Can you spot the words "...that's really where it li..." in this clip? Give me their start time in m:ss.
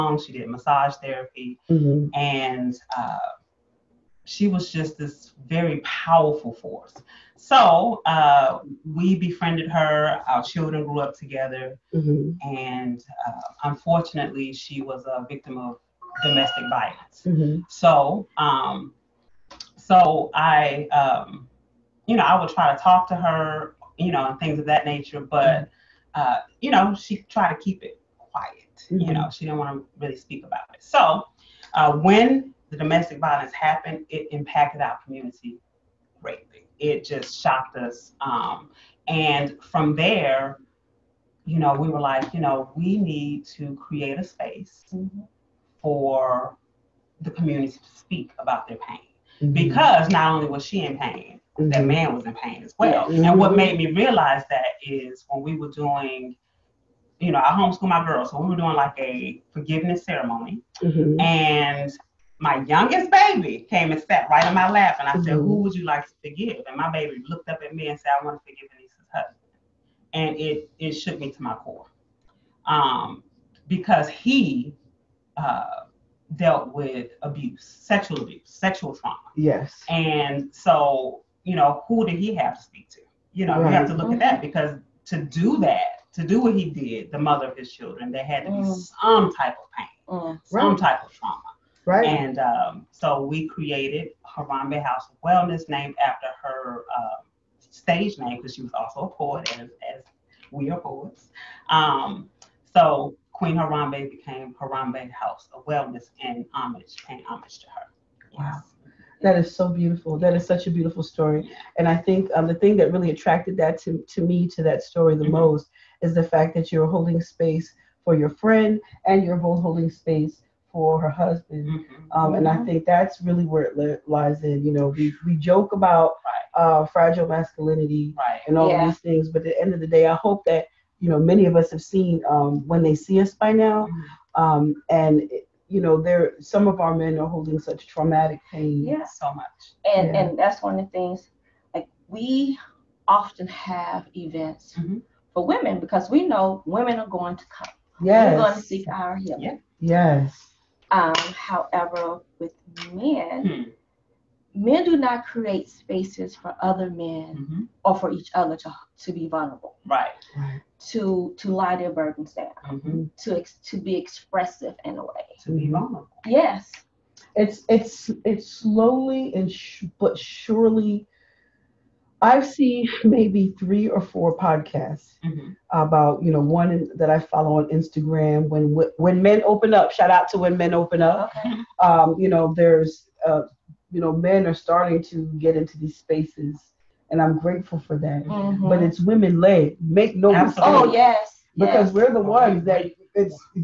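2:02.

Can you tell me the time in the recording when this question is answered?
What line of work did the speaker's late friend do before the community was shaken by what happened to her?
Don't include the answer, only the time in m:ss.
0:00.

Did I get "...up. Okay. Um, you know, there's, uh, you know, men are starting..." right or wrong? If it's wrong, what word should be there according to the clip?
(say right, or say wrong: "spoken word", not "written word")
right.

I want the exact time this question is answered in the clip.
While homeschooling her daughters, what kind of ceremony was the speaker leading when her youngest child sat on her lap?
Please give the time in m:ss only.
0:59.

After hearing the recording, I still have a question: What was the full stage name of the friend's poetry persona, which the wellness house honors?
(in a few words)
Queen Harambee.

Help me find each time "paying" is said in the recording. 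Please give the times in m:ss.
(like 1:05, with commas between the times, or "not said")
1:47.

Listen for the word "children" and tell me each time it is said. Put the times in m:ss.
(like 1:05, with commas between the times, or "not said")
0:10, 1:27.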